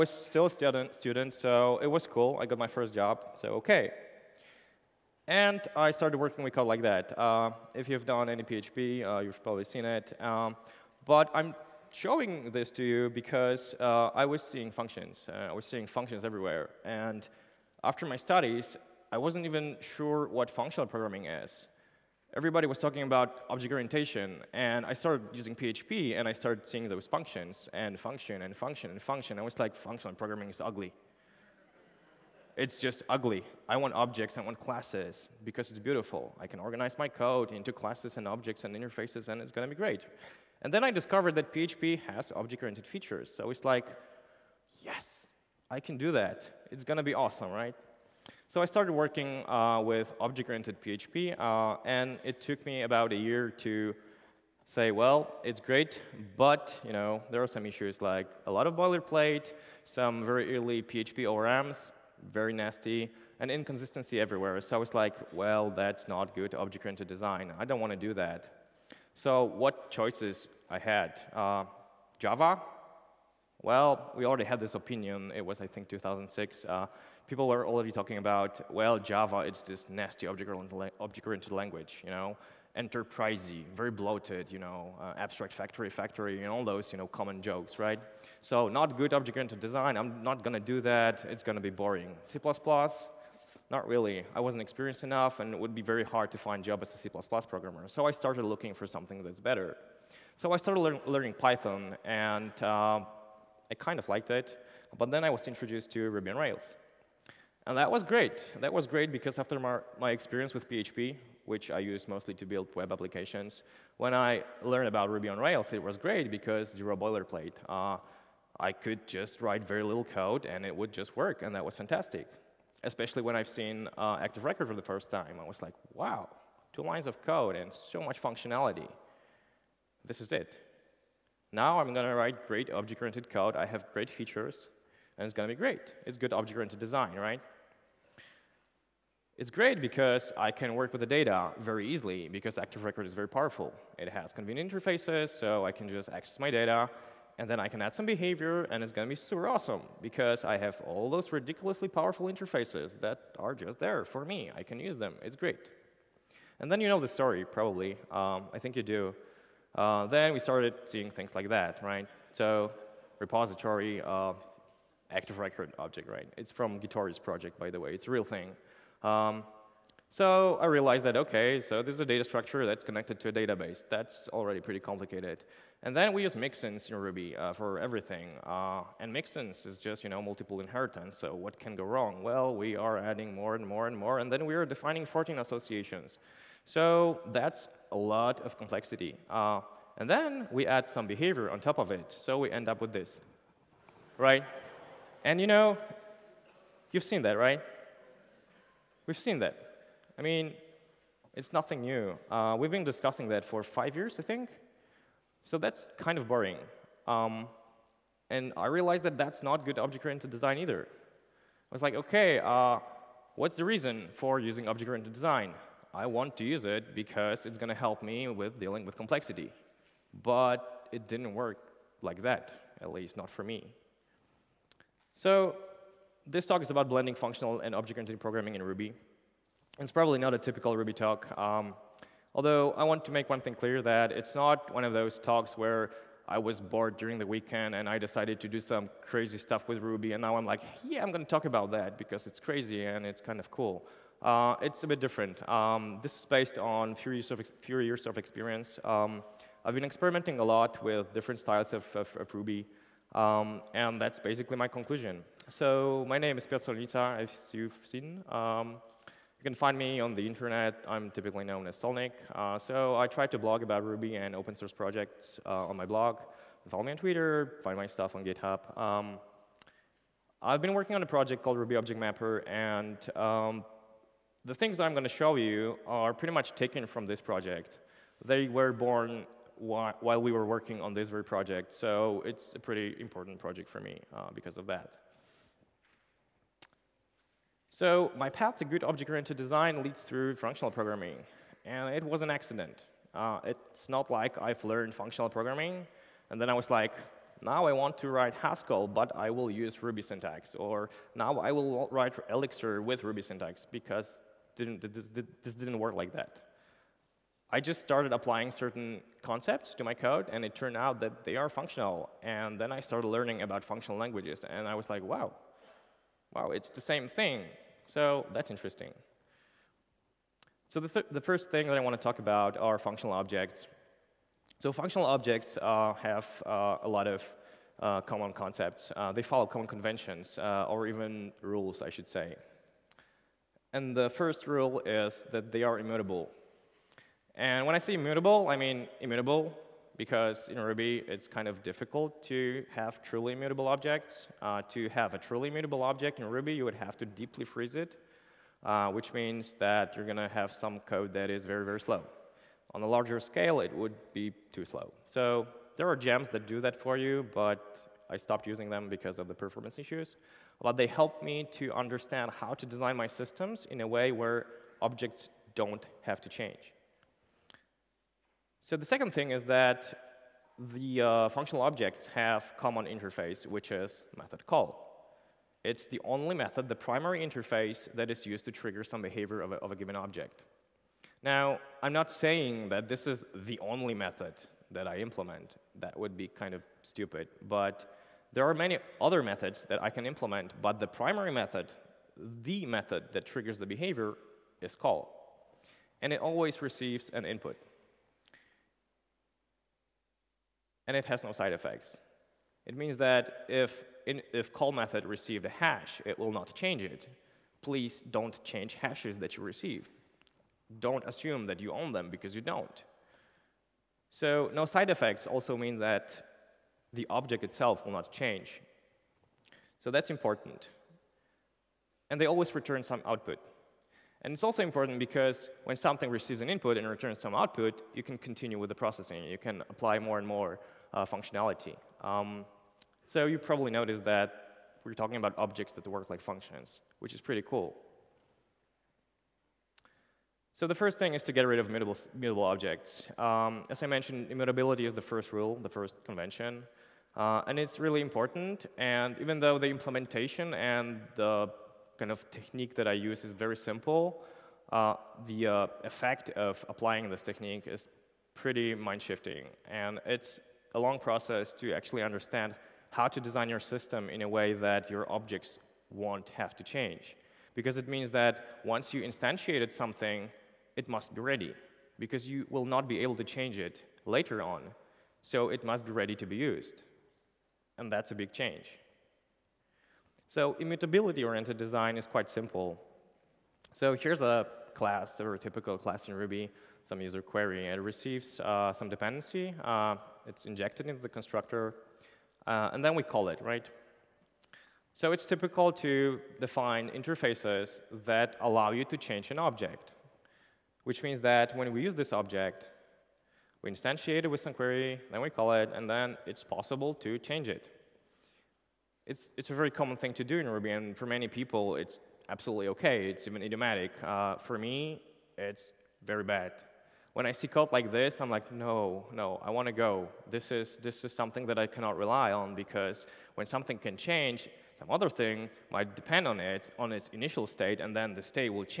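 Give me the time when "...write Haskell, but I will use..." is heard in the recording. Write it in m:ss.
4:58.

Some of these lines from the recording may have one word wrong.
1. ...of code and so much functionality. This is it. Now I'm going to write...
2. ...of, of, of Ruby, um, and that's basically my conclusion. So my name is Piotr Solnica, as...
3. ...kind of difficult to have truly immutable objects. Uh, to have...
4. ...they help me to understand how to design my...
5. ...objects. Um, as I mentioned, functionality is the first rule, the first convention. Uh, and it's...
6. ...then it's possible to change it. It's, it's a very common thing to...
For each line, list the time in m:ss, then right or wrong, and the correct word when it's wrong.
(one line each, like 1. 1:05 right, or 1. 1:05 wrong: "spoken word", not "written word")
1. 2:07 right
2. 4:11 right
3. 5:41 right
4. 6:00 right
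5. 7:22 wrong: "immutability", not "functionality"
6. 8:25 right.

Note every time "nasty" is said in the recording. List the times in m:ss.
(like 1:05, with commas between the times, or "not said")
1:02, 1:19.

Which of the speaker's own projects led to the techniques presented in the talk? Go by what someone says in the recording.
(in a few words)
Ruby Object Mapper.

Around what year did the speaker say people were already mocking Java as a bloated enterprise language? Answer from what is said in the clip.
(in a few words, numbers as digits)
2006.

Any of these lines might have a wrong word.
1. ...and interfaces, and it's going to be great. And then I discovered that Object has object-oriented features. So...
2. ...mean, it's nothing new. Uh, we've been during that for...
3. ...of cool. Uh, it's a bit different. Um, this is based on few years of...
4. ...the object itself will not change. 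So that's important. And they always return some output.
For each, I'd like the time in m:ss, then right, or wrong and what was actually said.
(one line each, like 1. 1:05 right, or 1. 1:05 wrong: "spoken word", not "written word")
1. 0:38 wrong: "PHP", not "Object"
2. 3:20 wrong: "discussing", not "during"
3. 4:03 right
4. 6:56 right.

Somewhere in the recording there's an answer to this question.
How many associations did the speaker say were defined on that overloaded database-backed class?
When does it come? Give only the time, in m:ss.
3:05.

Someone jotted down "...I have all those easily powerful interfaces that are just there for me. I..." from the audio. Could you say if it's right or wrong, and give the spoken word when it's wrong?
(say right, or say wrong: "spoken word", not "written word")
wrong: "ridiculously", not "easily".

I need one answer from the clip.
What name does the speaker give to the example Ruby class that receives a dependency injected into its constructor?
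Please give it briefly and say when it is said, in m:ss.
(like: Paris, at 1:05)
user query, at 8:07.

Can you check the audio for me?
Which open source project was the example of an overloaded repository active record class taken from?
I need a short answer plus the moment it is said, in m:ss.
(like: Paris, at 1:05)
Gitorious, at 2:46.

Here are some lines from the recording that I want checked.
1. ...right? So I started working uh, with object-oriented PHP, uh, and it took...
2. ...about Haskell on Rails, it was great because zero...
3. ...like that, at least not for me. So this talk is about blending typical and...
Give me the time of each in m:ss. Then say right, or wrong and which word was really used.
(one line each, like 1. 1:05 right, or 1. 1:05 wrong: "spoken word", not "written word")
1. 0:47 right
2. 1:54 wrong: "Ruby", not "Haskell"
3. 3:41 wrong: "functional", not "typical".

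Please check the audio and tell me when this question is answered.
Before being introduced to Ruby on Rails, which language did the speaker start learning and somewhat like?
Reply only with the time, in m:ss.
1:41.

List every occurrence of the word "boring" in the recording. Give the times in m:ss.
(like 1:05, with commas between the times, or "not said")
1:31, 3:26.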